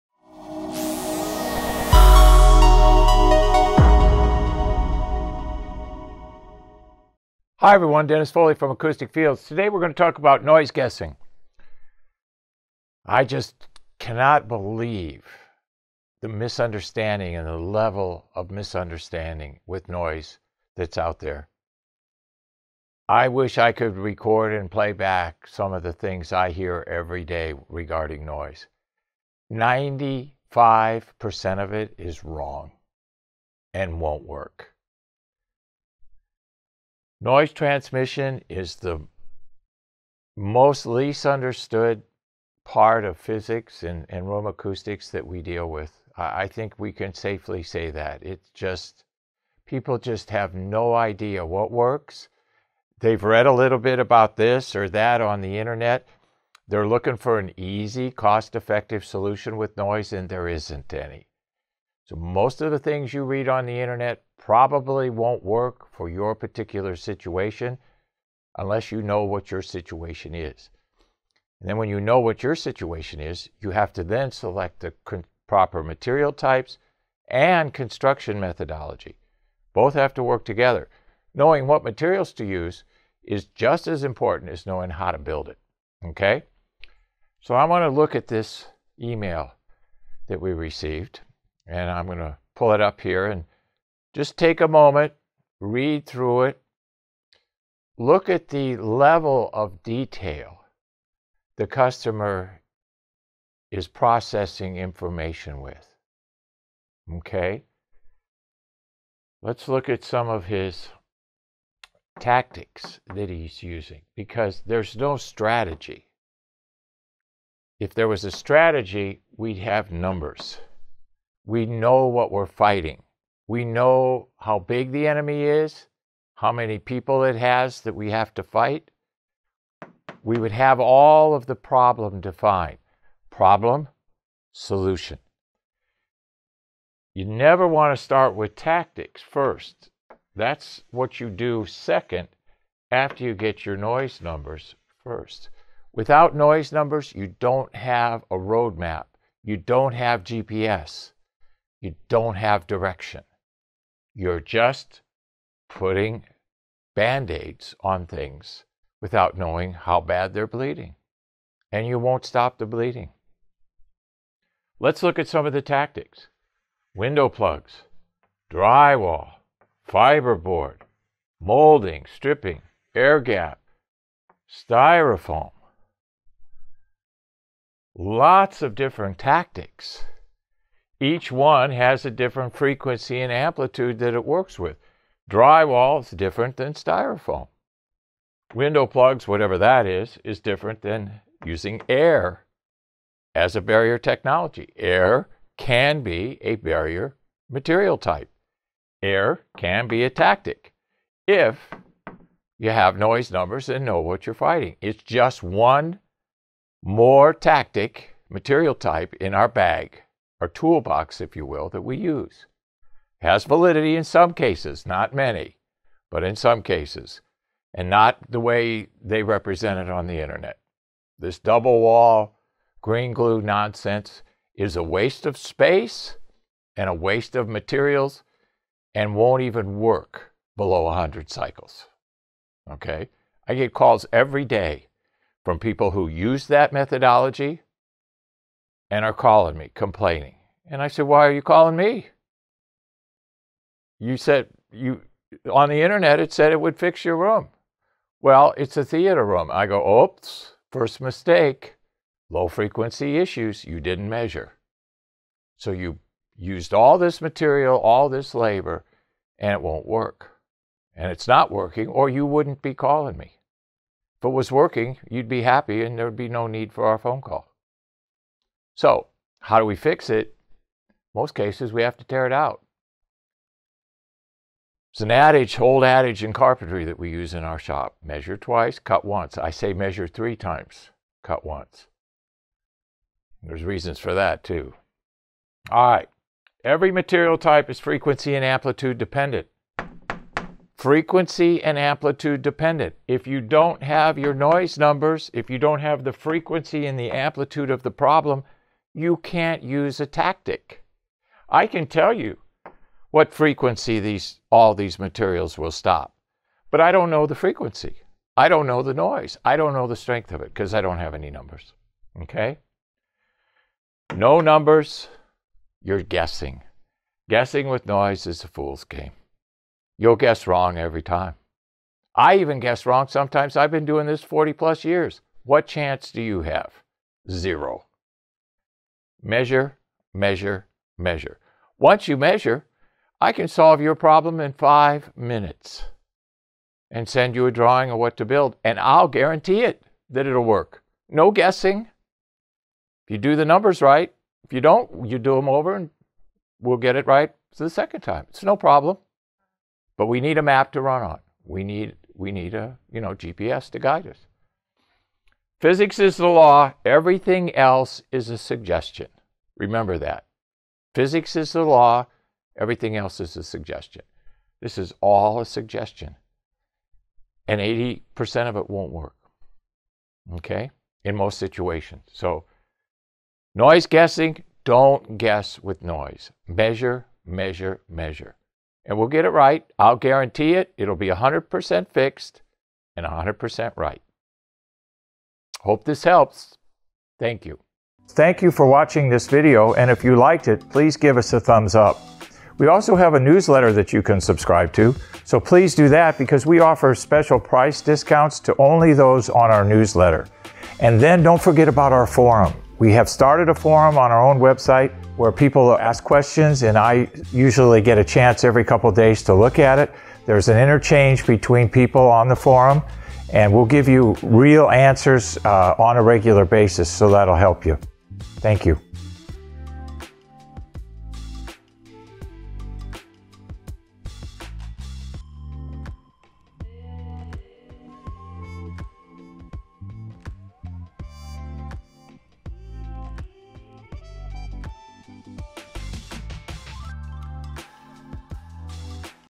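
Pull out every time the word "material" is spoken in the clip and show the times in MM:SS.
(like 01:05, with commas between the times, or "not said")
01:15, 01:21, 03:17, 03:28, 03:47, 04:17, 04:46, 05:04.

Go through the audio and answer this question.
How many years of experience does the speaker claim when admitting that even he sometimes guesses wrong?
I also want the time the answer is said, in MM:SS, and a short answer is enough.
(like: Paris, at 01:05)
40 plus years, at 05:24.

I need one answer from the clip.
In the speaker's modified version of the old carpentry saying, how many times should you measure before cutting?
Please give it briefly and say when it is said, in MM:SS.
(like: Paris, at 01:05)
3, at 04:40.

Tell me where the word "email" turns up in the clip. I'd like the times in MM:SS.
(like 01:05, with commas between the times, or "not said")
01:29.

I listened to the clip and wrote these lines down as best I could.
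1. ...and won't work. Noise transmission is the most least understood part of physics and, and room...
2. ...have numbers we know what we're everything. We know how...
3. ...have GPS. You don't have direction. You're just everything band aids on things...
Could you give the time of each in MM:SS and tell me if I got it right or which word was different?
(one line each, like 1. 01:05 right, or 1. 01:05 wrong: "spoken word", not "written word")
1. 00:33 right
2. 01:59 wrong: "fighting", not "everything"
3. 02:29 wrong: "putting", not "everything".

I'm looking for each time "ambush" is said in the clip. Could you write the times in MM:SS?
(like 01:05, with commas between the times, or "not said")
not said.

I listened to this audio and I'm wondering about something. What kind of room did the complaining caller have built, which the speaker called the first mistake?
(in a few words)
theater room.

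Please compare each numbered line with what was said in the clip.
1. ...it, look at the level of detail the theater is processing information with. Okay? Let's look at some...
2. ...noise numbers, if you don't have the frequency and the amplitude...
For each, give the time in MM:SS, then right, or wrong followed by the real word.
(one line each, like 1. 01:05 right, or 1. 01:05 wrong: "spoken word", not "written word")
1. 01:36 wrong: "customer", not "theater"
2. 04:54 right.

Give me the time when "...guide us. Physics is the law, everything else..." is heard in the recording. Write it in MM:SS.
05:53.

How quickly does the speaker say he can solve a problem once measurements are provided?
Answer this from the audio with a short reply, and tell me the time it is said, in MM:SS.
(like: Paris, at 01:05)
5 minutes, at 05:34.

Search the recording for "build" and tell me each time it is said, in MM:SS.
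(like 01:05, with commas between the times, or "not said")
01:25, 05:38.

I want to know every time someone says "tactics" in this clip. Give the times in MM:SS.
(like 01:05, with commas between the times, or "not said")
01:52, 02:18, 02:45, 02:59, 03:20, 03:27, 05:00.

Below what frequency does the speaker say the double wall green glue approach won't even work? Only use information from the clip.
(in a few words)
100 cycles.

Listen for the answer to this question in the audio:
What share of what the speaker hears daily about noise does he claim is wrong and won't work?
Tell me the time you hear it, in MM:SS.
00:29.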